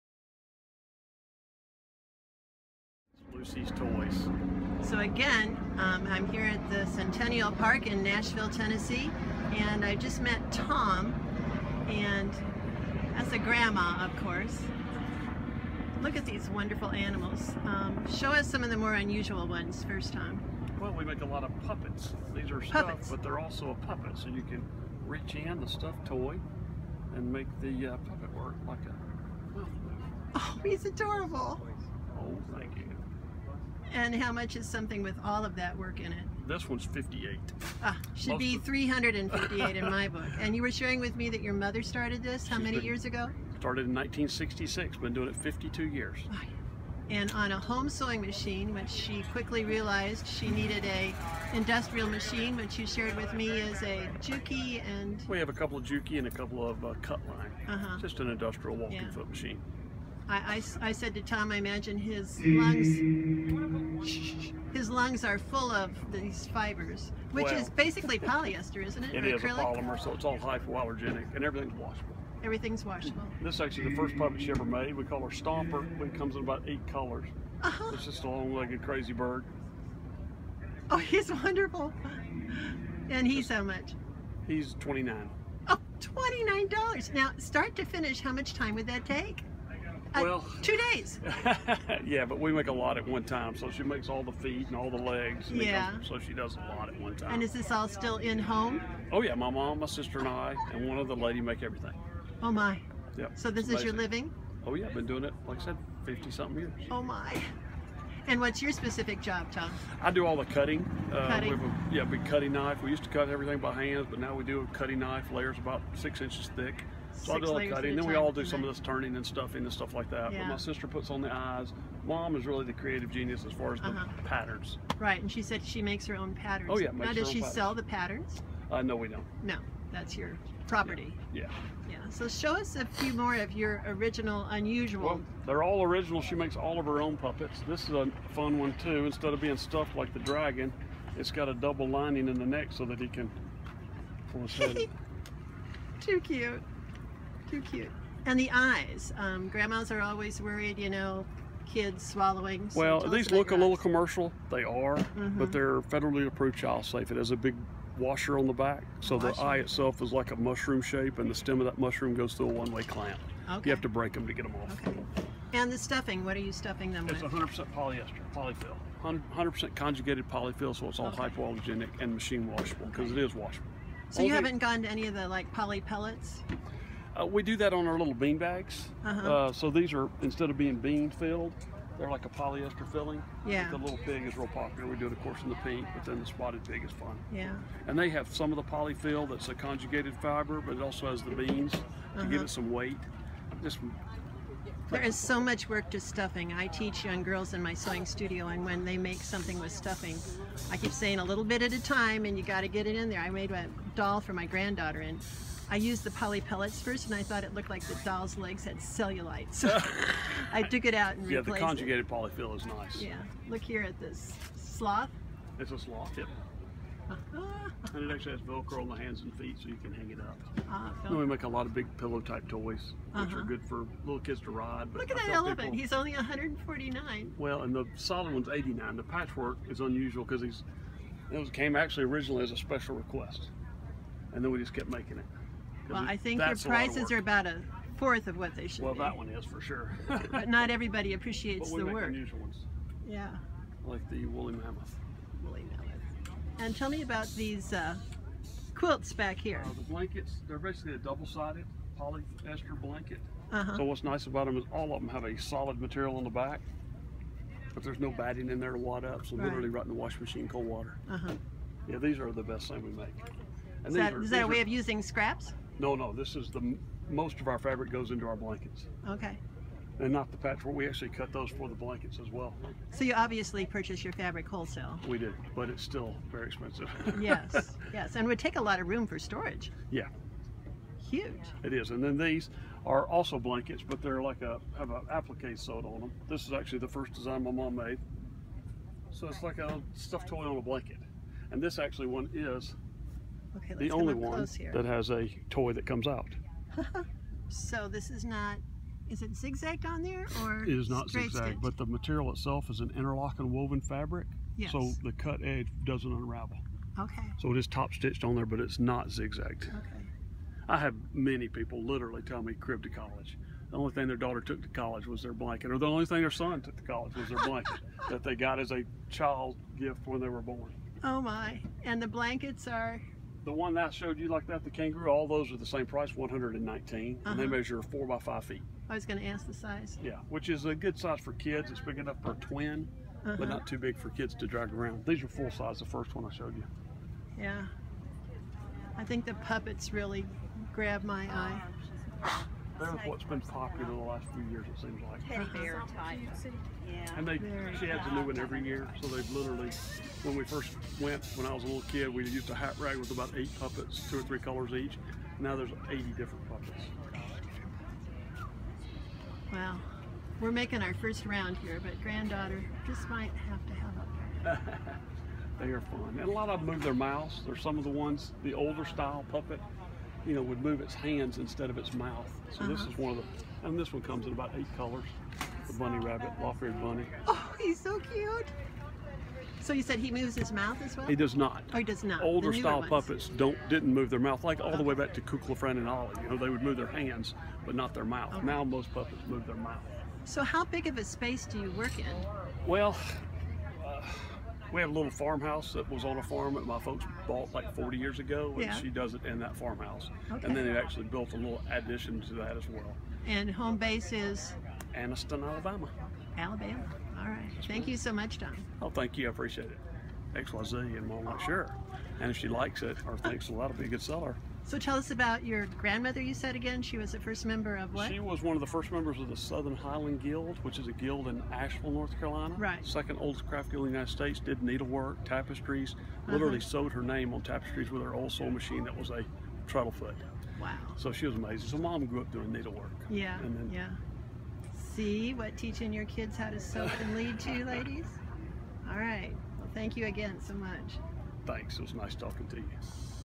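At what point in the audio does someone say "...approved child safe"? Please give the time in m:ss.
2:36.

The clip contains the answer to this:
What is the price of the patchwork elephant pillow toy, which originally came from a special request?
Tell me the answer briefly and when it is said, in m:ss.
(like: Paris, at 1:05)
$149, at 3:46.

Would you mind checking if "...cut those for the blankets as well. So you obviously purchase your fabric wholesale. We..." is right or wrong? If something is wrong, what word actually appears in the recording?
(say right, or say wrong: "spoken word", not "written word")
right.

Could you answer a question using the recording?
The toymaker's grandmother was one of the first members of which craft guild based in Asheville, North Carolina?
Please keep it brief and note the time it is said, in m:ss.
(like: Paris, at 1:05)
Southern Highland Guild, at 6:59.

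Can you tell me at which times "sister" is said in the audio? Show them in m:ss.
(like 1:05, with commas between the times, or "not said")
1:39, 2:00.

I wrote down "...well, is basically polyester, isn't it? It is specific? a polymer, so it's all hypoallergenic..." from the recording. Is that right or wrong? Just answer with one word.
wrong.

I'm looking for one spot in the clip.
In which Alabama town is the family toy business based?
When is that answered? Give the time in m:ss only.
6:44.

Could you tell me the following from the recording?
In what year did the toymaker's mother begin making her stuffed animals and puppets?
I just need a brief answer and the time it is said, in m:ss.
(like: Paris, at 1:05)
1966, at 0:43.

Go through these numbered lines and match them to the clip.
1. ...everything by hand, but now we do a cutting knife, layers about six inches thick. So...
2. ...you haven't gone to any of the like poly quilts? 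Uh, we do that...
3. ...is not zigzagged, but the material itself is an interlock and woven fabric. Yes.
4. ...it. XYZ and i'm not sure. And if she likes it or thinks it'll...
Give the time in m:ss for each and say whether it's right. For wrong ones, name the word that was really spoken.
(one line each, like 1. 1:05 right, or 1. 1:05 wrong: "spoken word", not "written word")
1. 1:53 right
2. 2:54 wrong: "pellets", not "quilts"
3. 5:00 right
4. 6:49 right.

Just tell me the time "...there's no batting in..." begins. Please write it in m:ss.
4:17.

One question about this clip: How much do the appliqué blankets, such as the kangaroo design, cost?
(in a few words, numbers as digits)
$119.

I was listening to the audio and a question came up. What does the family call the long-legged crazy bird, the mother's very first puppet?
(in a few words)
Stomper.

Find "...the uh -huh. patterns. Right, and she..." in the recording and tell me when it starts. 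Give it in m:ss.
2:03.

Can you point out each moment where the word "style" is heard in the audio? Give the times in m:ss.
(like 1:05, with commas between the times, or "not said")
6:08, 6:22.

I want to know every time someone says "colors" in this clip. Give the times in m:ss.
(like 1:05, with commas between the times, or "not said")
1:16, 5:54, 6:14.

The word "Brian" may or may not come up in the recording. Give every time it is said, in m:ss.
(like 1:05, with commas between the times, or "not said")
not said.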